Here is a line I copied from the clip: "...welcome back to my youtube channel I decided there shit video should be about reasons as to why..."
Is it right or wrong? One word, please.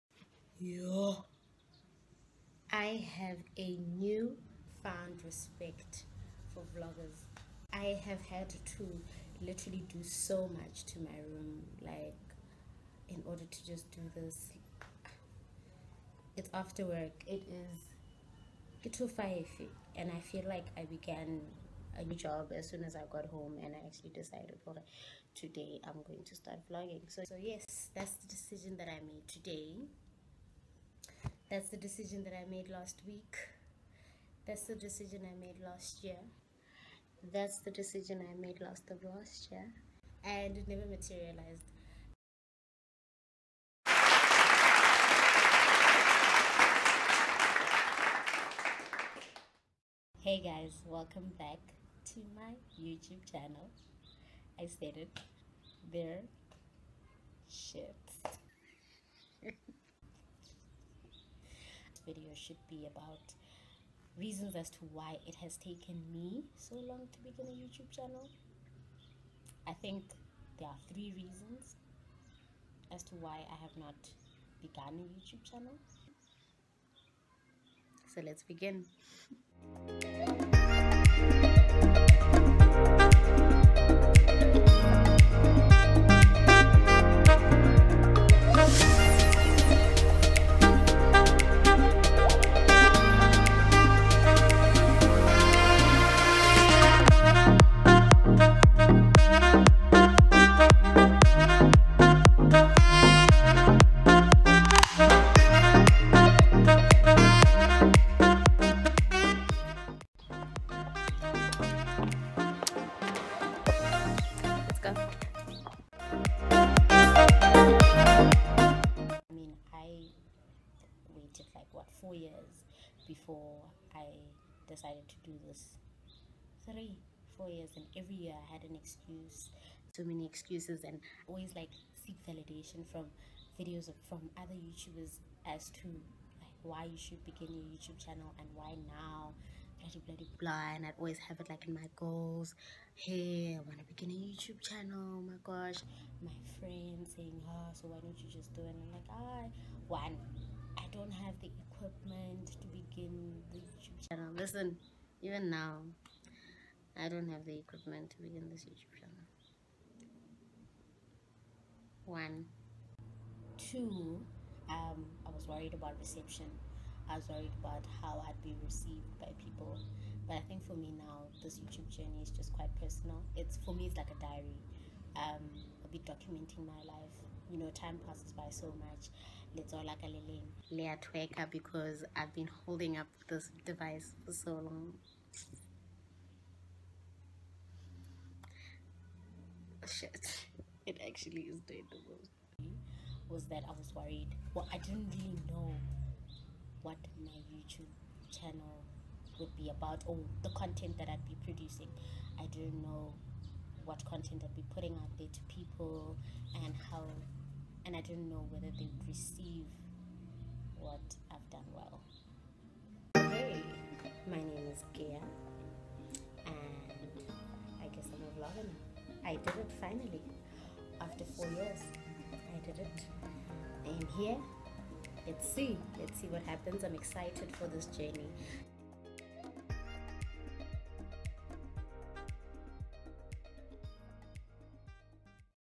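wrong.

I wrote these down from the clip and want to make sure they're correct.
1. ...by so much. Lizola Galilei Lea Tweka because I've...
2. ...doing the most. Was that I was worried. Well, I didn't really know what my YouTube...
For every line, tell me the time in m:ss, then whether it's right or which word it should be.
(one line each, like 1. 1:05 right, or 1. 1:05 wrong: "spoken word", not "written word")
1. 2:58 right
2. 3:11 right.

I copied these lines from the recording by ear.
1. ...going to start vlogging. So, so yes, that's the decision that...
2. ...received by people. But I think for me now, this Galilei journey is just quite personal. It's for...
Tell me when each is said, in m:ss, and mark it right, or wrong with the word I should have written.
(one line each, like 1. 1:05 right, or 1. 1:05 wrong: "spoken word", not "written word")
1. 0:26 right
2. 2:48 wrong: "YouTube", not "Galilei".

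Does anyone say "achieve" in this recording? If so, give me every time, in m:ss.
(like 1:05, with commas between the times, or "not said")
not said.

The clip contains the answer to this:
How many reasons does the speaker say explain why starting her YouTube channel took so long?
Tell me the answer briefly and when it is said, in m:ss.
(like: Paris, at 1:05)
3, at 1:10.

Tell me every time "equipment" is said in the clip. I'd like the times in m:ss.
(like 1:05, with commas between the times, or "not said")
2:31, 2:37.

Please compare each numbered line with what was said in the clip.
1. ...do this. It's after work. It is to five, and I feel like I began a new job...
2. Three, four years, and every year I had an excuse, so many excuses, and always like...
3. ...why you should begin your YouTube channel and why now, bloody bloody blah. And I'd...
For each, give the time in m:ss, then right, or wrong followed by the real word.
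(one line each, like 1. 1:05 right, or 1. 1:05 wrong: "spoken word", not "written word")
1. 0:13 right
2. 2:06 right
3. 2:16 right.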